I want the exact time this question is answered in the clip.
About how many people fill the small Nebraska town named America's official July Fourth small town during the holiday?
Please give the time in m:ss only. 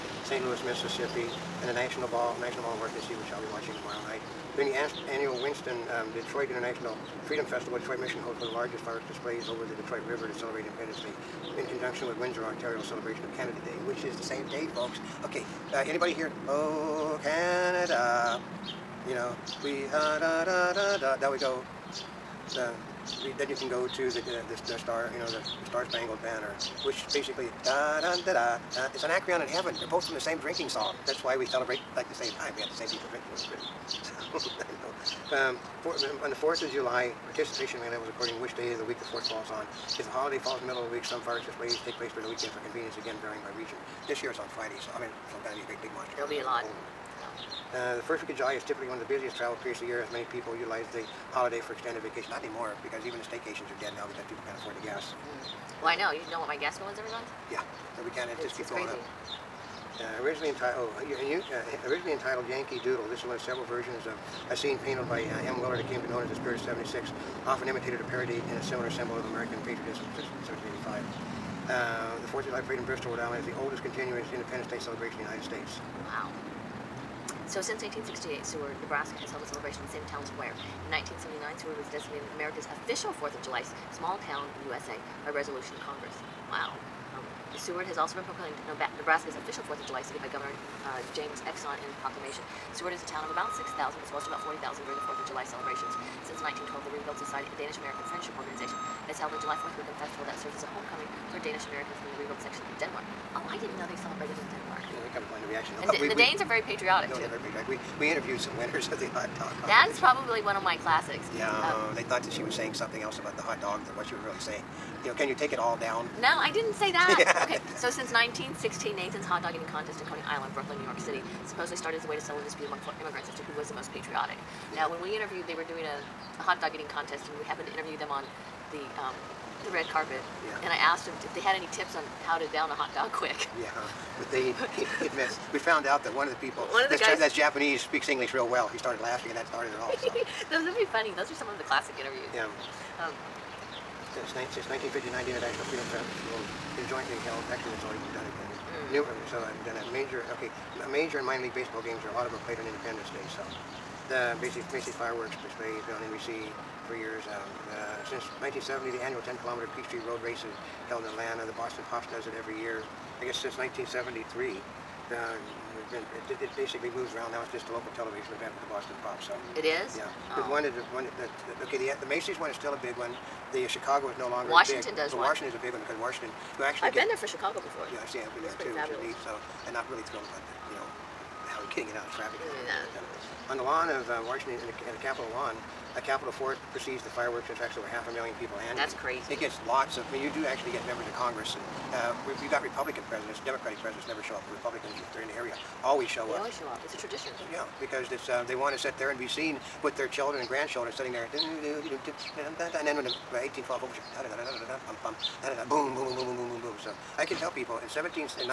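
1:34.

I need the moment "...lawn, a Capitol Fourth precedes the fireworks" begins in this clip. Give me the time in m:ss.
3:05.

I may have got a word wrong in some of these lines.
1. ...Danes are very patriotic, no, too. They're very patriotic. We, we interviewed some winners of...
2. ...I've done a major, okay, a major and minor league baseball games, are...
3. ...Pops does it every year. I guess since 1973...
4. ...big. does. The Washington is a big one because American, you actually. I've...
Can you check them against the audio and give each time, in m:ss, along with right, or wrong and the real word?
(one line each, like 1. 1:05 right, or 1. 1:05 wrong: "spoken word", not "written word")
1. 1:46 right
2. 2:29 right
3. 2:41 right
4. 2:54 wrong: "Washington", not "American".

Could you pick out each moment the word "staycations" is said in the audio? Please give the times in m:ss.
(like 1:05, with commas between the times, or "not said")
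0:53.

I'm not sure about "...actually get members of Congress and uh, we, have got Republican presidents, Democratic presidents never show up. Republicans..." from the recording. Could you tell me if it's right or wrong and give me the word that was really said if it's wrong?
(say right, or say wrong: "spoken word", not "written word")
right.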